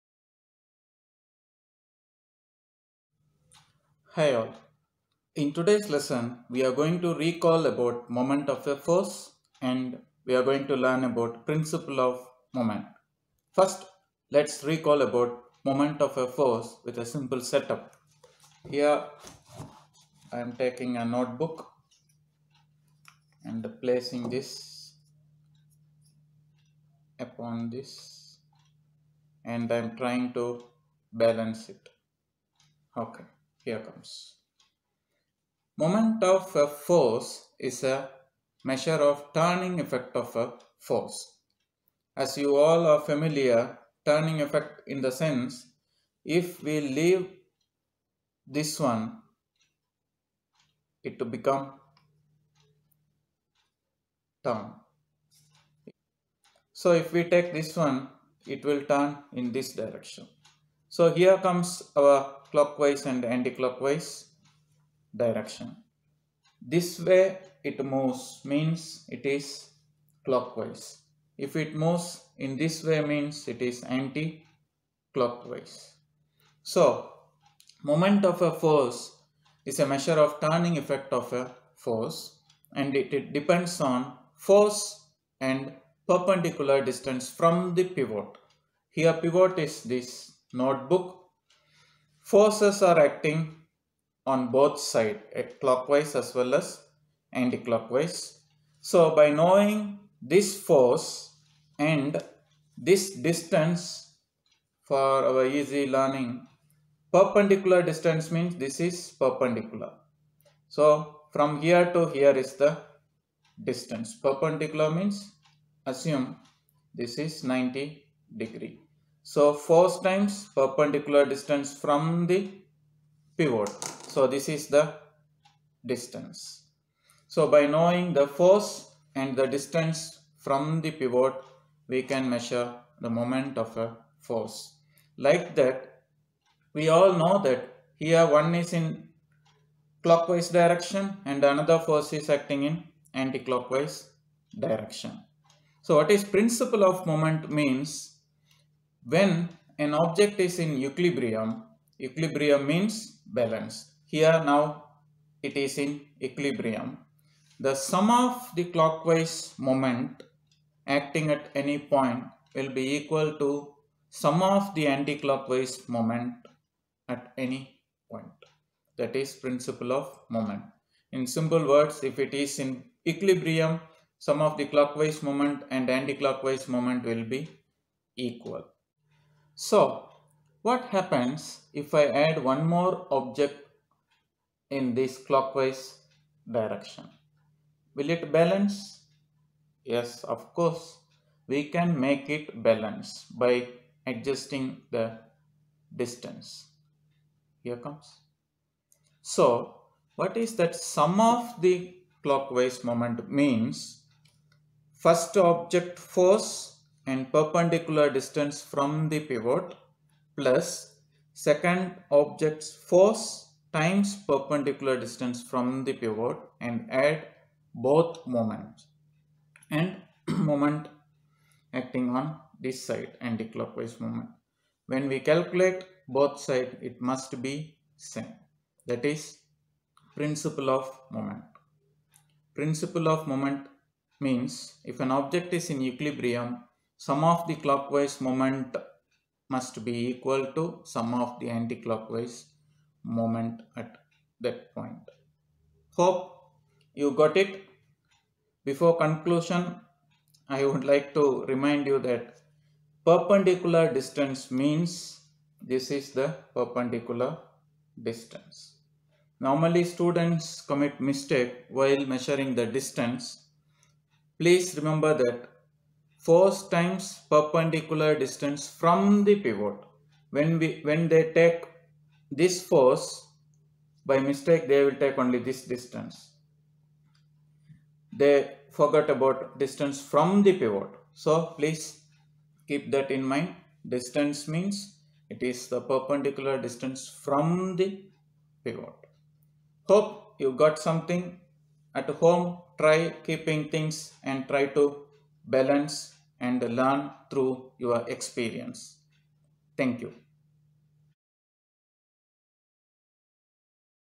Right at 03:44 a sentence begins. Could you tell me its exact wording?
When we calculate both side it must be same that is principle of moment.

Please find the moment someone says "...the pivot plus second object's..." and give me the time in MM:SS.
03:29.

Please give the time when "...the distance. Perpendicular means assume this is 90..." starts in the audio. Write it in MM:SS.
01:52.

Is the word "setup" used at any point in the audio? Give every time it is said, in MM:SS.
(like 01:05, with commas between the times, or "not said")
00:17.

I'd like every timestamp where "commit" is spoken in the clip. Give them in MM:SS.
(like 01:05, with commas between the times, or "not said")
04:20.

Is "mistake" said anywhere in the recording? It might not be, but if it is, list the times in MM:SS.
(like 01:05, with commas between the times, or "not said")
04:21, 04:34.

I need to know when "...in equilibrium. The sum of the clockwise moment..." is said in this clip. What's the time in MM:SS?
02:35.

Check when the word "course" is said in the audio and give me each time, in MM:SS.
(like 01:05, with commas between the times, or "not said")
03:10.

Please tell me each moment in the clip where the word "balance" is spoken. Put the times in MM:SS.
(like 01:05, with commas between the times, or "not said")
00:31, 02:33, 03:08, 03:12, 04:55.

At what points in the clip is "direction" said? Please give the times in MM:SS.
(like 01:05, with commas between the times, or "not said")
00:59, 01:05, 02:20, 02:24, 03:06.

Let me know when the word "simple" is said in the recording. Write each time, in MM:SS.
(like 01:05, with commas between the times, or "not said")
00:17, 02:51.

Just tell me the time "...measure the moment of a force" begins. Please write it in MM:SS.
02:12.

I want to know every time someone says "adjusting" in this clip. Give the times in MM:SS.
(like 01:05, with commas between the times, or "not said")
03:14.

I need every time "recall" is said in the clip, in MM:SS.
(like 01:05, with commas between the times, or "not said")
00:07, 00:14.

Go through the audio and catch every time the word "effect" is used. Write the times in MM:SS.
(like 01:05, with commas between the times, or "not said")
00:39, 00:44, 01:20.